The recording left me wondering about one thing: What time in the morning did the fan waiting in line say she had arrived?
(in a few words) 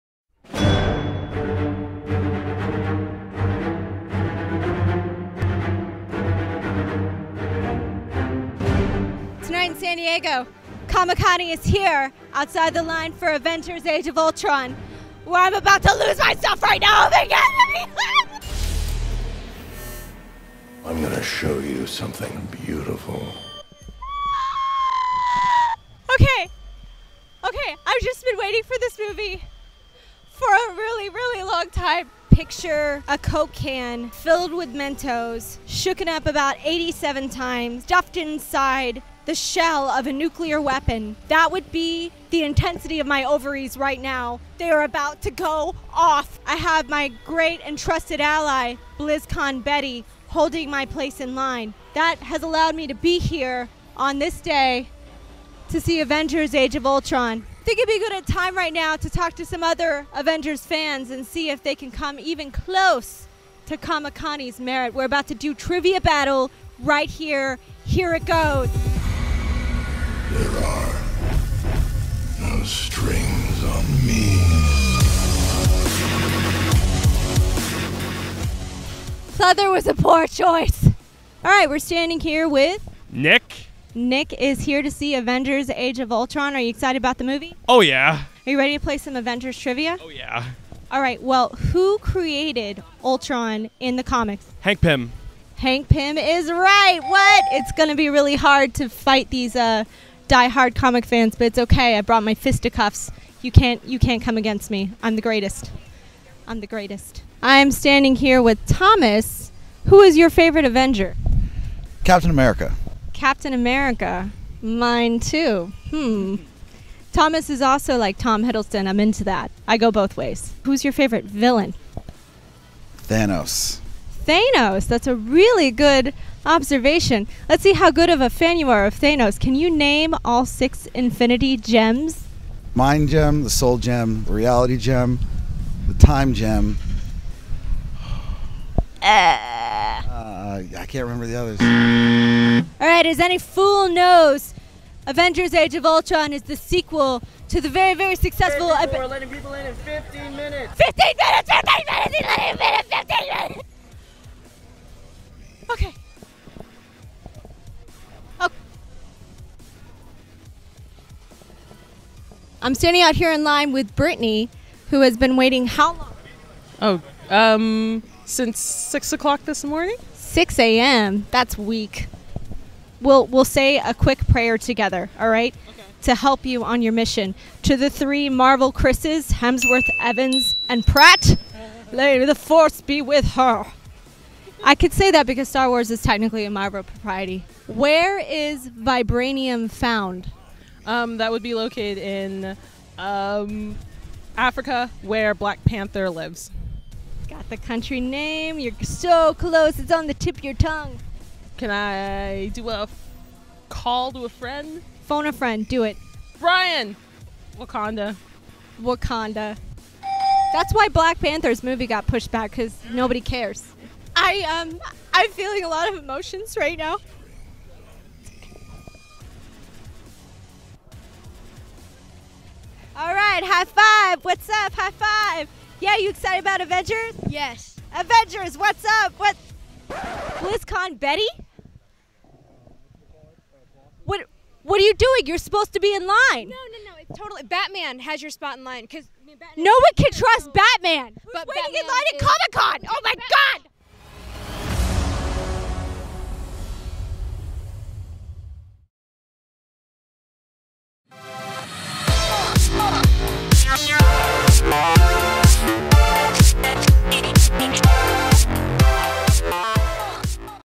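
6 a.m.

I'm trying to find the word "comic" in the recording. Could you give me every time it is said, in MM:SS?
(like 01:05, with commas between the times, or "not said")
00:10, 01:03, 01:34, 01:40, 04:02.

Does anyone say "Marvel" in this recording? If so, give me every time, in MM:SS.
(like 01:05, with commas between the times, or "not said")
02:58, 03:06.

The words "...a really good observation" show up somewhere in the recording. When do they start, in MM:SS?
02:05.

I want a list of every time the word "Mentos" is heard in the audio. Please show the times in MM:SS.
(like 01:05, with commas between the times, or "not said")
00:34.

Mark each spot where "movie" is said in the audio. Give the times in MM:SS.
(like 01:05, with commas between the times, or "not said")
00:29, 01:27, 03:31.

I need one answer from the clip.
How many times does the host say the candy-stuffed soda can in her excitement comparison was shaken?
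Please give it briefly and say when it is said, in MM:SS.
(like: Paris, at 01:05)
87, at 00:36.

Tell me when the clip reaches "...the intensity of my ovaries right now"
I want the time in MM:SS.
00:42.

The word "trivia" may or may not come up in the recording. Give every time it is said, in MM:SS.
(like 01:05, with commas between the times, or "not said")
01:05, 01:29.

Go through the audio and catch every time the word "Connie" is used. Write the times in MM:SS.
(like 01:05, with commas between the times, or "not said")
00:11, 01:04.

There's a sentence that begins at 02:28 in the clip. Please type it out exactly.
We're letting people in in 15 minutes.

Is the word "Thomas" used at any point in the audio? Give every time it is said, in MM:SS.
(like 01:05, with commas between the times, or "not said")
01:48, 01:57.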